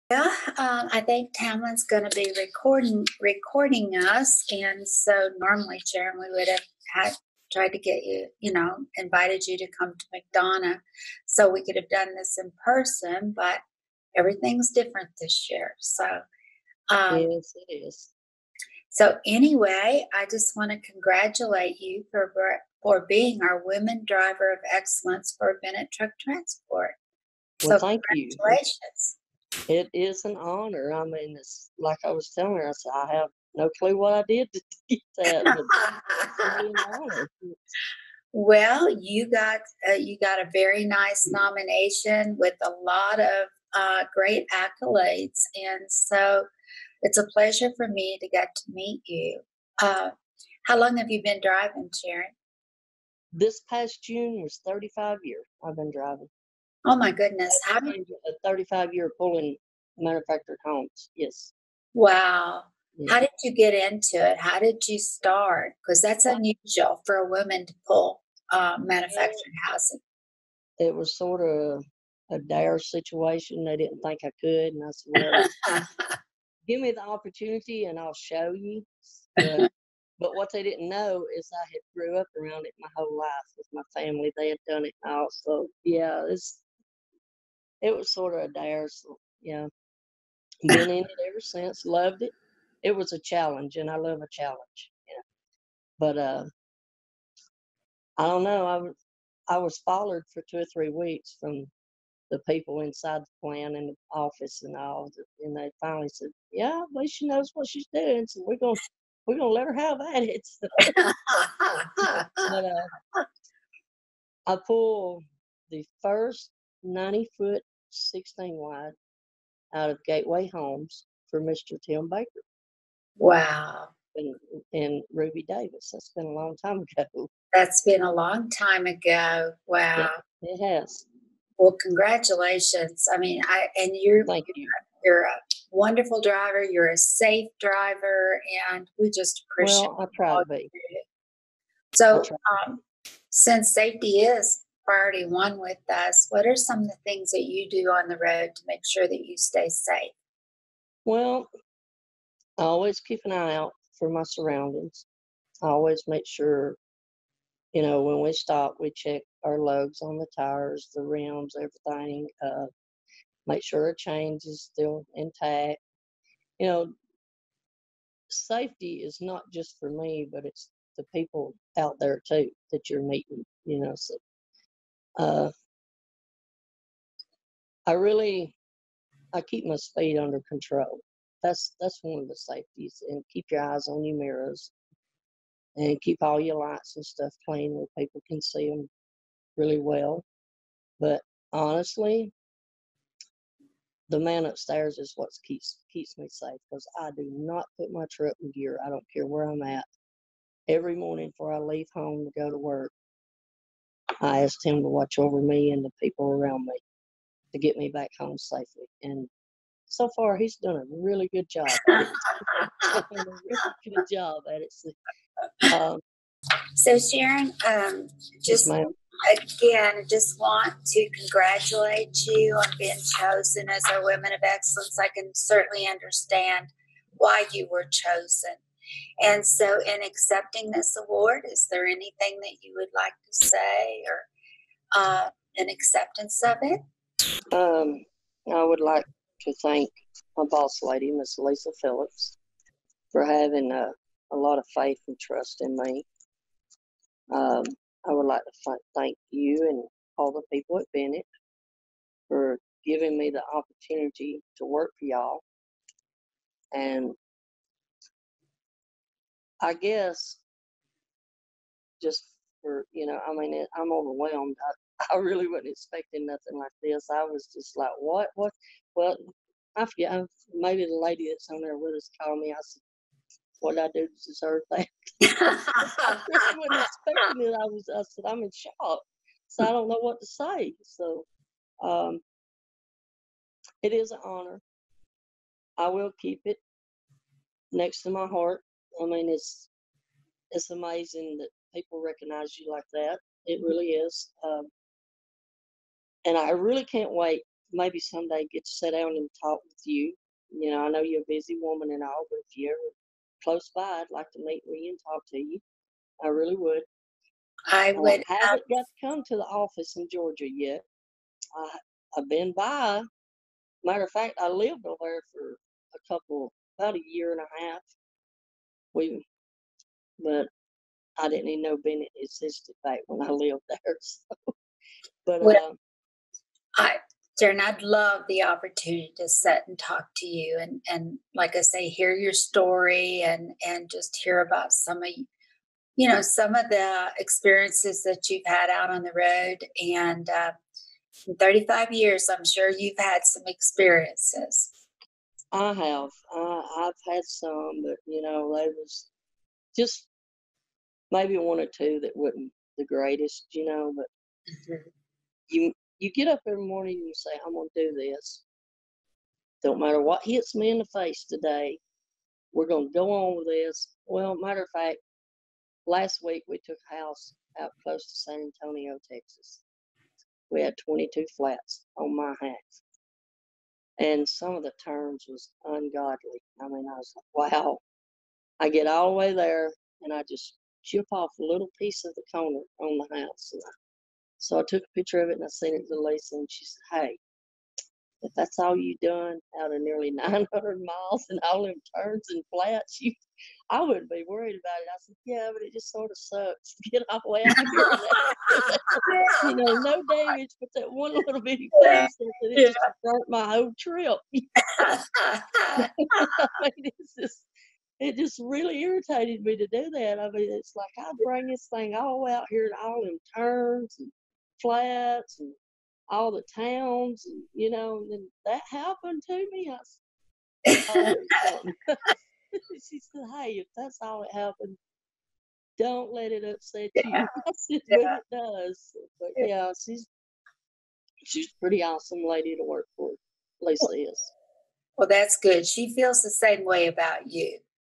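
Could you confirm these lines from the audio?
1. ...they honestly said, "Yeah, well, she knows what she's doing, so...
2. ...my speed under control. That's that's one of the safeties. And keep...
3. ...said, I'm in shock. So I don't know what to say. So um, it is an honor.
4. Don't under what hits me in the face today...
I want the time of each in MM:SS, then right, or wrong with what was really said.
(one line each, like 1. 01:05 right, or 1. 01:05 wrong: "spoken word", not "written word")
1. 01:45 wrong: "finally", not "honestly"
2. 02:59 right
3. 04:38 right
4. 05:59 wrong: "matter", not "under".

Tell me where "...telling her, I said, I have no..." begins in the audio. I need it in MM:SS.
00:32.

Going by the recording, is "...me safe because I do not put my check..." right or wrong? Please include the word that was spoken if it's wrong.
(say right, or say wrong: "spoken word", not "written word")
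wrong: "truck", not "check".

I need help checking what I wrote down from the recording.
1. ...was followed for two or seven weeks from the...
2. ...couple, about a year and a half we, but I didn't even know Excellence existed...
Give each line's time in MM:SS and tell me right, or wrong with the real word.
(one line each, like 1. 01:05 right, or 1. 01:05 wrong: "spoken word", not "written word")
1. 01:39 wrong: "three", not "seven"
2. 05:16 wrong: "Bennett", not "Excellence".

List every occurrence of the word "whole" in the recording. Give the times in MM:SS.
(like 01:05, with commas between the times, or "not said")
01:22, 06:43.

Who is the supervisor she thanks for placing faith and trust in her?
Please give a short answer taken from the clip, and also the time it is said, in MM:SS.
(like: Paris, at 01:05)
Lisa Phillips, at 04:01.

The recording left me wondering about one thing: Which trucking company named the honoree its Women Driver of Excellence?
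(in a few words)
Bennett Truck Transport.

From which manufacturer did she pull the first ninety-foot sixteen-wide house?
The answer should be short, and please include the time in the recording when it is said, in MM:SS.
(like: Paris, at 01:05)
Gateway Homes, at 02:00.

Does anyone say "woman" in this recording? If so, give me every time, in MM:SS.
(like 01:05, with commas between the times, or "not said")
01:07, 05:01.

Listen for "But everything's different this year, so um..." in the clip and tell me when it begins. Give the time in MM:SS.
00:13.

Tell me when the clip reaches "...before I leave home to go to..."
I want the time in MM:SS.
03:21.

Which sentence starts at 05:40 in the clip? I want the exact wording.
Uh, in 35 years, I'm sure you've had some experiences.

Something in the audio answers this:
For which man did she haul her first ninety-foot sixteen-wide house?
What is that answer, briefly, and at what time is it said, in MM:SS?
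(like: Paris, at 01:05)
Tim Baker, at 02:01.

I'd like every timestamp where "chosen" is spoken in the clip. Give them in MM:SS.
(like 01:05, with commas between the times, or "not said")
03:43, 03:47.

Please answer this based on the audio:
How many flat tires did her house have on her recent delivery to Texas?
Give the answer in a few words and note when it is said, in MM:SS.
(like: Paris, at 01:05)
22, at 06:10.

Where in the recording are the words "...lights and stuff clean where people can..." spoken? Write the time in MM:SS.
03:06.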